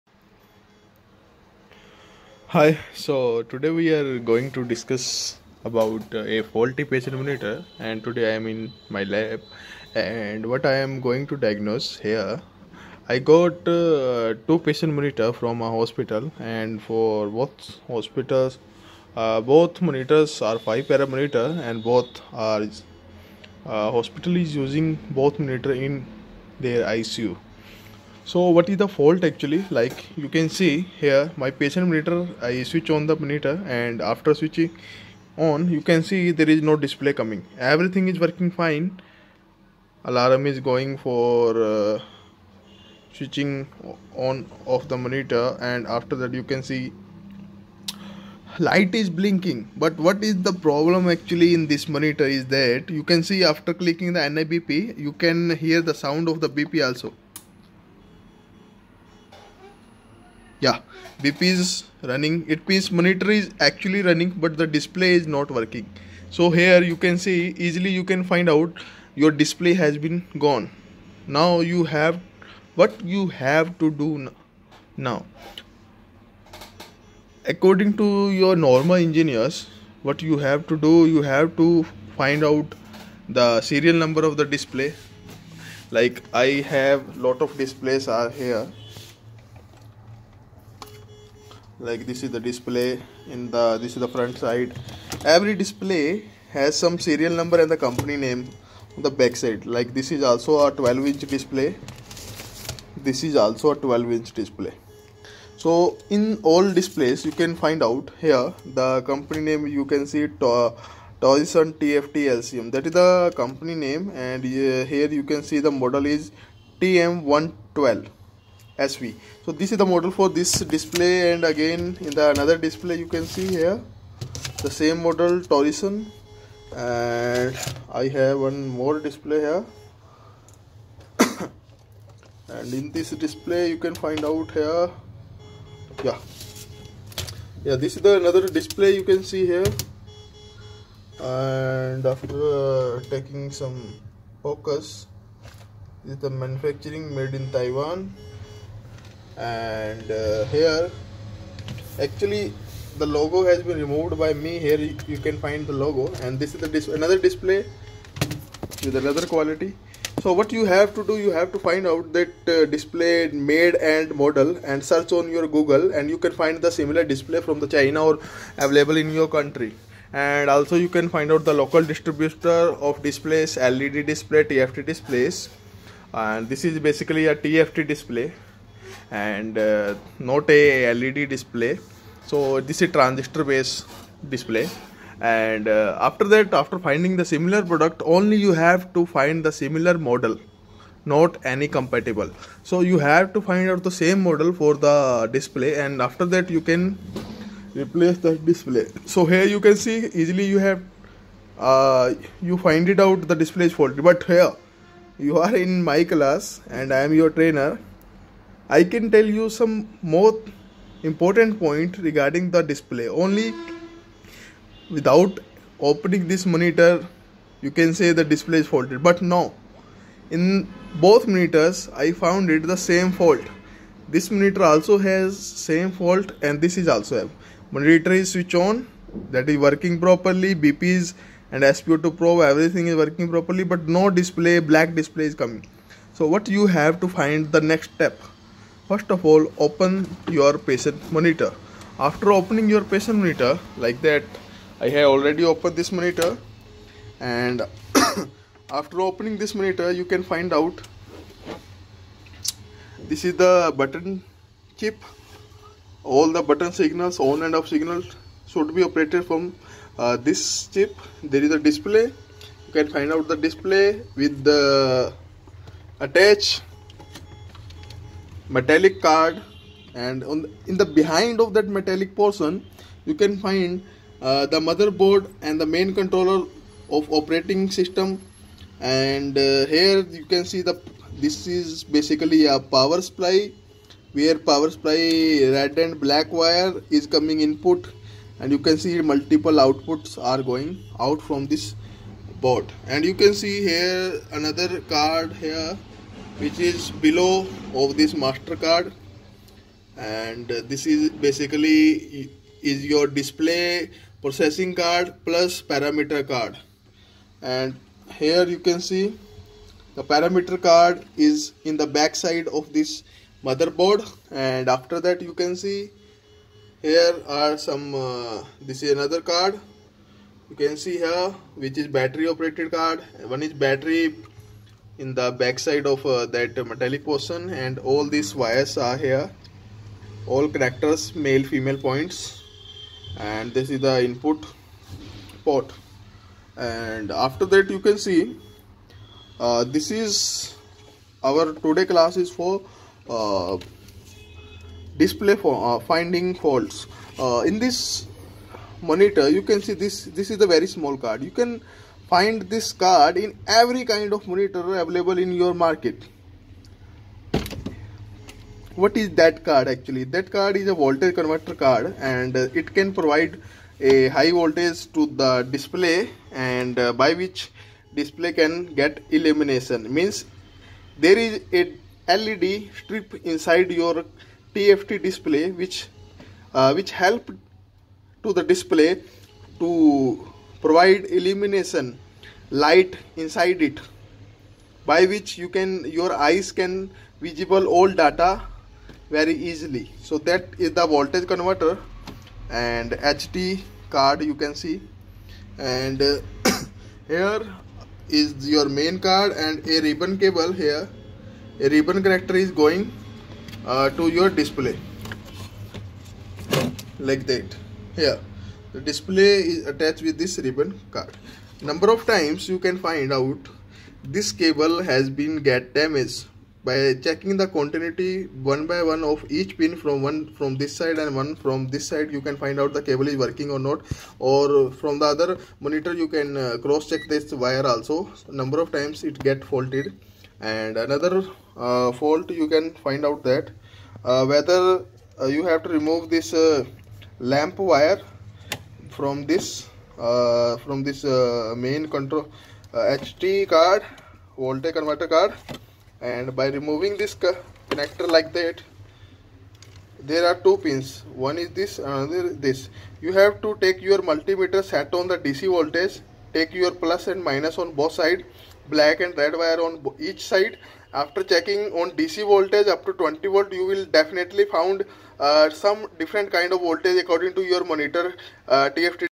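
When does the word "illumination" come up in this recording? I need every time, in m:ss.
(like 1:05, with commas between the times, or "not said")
6:09, 6:21.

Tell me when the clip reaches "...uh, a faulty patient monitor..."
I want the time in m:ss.
0:06.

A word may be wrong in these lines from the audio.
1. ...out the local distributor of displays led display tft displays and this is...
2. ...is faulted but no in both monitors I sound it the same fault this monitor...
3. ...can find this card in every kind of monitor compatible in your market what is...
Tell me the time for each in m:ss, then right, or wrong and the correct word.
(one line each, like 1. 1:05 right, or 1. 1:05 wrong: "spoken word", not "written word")
1. 2:51 right
2. 3:38 wrong: "found", not "sound"
3. 5:51 wrong: "available", not "compatible".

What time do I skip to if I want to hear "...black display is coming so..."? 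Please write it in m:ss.
3:54.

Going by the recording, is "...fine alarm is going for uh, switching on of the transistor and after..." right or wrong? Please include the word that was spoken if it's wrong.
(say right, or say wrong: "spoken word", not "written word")
wrong: "monitor", not "transistor".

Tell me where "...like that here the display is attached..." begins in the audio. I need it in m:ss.
6:46.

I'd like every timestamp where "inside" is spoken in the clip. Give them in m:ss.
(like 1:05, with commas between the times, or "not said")
6:13, 6:23.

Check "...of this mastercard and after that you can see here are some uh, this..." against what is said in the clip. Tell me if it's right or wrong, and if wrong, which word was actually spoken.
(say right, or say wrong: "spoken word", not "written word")
wrong: "motherboard", not "mastercard".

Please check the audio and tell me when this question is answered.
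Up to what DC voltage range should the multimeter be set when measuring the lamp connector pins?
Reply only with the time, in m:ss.
7:42.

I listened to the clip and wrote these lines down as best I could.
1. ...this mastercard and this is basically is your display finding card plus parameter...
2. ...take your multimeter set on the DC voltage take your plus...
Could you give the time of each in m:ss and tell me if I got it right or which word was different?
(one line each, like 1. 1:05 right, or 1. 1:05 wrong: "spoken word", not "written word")
1. 4:57 wrong: "processing", not "finding"
2. 7:33 right.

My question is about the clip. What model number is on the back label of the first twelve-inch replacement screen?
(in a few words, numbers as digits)
TM112 SV.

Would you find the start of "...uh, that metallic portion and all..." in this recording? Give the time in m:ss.
5:26.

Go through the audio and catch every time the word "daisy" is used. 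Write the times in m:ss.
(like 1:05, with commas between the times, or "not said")
not said.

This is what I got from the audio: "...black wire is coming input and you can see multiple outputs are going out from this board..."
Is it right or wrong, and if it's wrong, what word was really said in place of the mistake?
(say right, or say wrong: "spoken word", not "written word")
right.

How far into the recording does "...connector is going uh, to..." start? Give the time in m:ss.
6:42.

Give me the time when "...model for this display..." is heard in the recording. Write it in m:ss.
1:59.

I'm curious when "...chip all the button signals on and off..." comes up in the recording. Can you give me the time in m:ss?
4:14.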